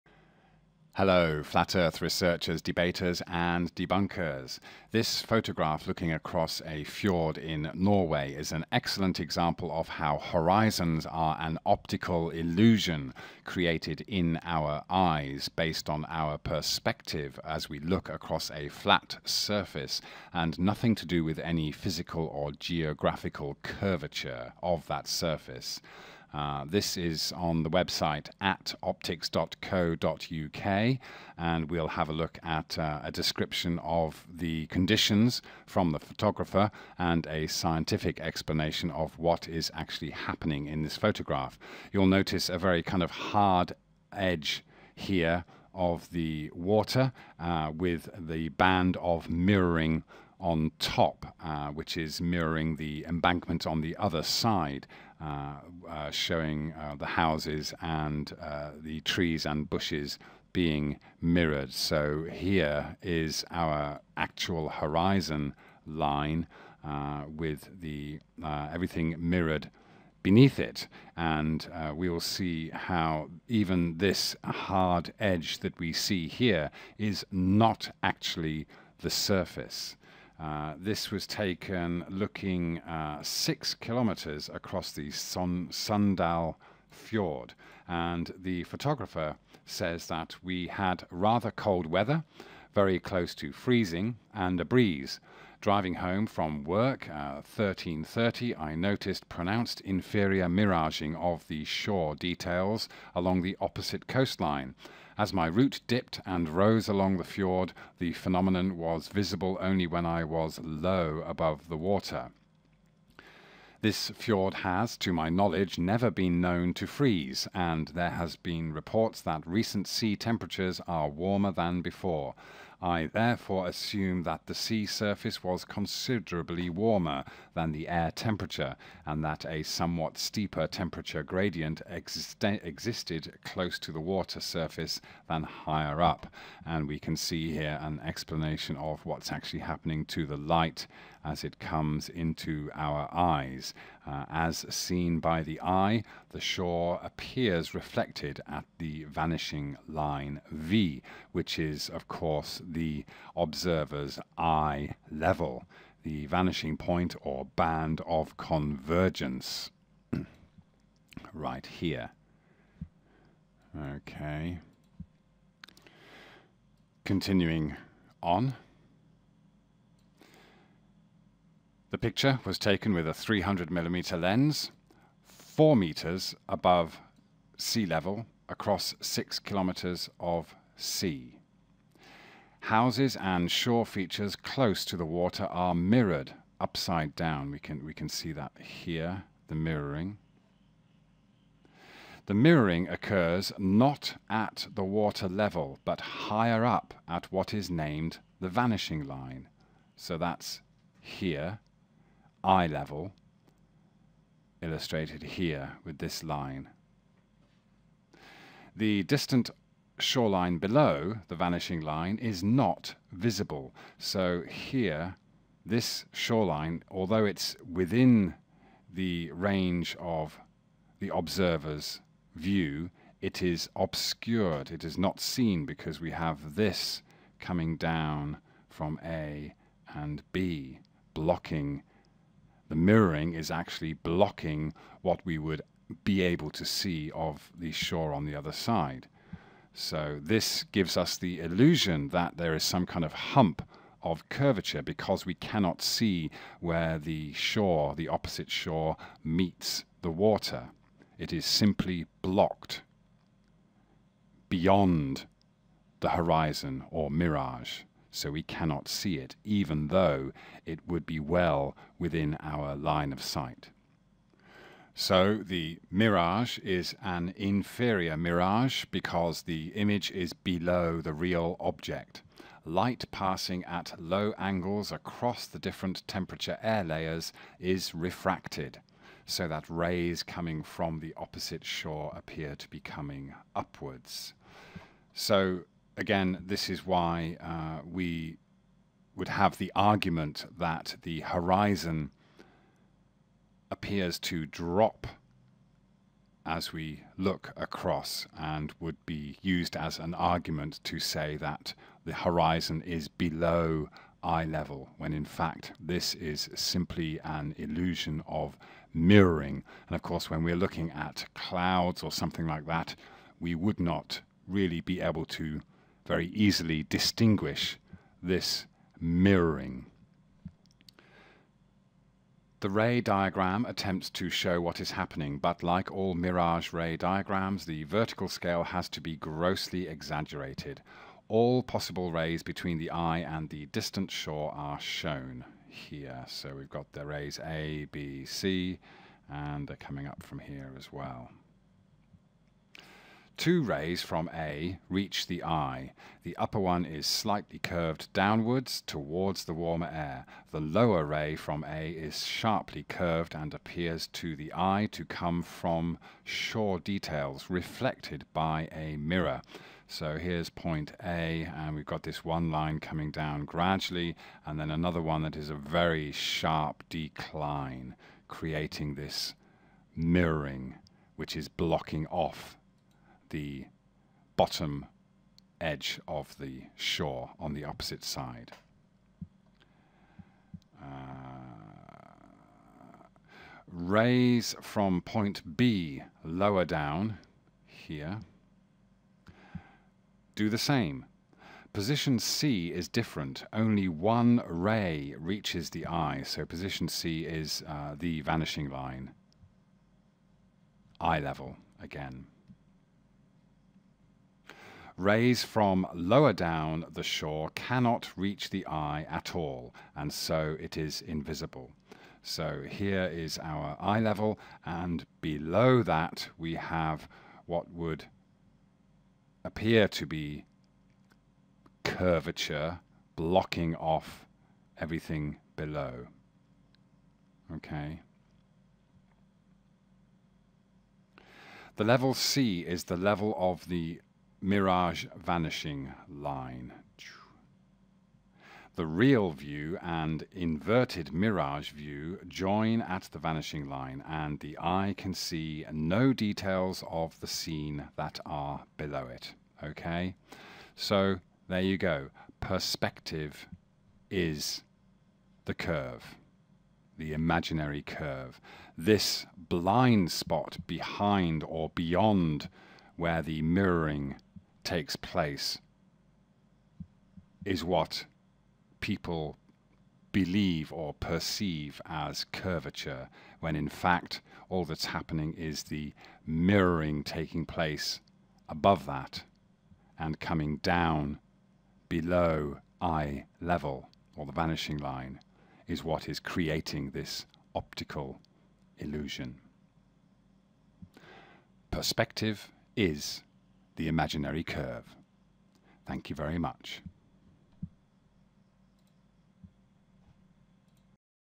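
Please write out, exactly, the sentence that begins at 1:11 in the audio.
And uh, we will see how even this hard edge that we see here is not actually the surface.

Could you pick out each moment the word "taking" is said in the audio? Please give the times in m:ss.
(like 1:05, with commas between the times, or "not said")
7:57.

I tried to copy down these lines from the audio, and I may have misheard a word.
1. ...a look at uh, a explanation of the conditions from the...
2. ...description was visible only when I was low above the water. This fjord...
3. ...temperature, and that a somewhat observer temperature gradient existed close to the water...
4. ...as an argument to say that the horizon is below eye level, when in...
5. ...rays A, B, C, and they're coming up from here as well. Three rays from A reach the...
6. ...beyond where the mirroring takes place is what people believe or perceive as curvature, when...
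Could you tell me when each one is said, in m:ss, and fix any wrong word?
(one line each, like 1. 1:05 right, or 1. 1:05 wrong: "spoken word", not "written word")
1. 0:32 wrong: "description", not "explanation"
2. 1:48 wrong: "phenomenon", not "description"
3. 2:08 wrong: "steeper", not "observer"
4. 4:59 right
5. 5:37 wrong: "Two", not "Three"
6. 7:41 right.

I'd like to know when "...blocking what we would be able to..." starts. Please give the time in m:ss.
3:53.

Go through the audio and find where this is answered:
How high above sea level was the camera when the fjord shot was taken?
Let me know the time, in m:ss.
2:55.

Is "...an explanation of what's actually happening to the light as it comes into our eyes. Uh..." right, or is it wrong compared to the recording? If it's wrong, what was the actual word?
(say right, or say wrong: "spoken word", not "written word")
right.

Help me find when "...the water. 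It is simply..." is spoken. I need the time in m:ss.
4:10.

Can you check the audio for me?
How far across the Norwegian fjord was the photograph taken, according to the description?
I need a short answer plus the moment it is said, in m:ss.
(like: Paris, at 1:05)
6 kilometers, at 1:23.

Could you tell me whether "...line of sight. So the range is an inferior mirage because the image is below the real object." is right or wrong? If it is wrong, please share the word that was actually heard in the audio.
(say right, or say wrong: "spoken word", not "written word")
wrong: "mirage", not "range".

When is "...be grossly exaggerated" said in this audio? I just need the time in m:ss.
5:29.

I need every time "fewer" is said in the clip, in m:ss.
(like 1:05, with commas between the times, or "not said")
not said.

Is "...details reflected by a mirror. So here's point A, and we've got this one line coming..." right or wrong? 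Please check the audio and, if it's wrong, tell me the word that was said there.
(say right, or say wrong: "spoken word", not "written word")
right.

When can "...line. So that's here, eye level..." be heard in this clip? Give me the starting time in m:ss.
3:19.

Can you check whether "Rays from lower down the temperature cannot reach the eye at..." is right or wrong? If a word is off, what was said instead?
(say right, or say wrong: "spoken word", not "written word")
wrong: "shore", not "temperature".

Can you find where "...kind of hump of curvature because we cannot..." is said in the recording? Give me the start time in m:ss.
4:02.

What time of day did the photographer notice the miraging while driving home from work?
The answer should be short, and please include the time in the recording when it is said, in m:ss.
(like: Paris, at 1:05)
13.30, at 1:37.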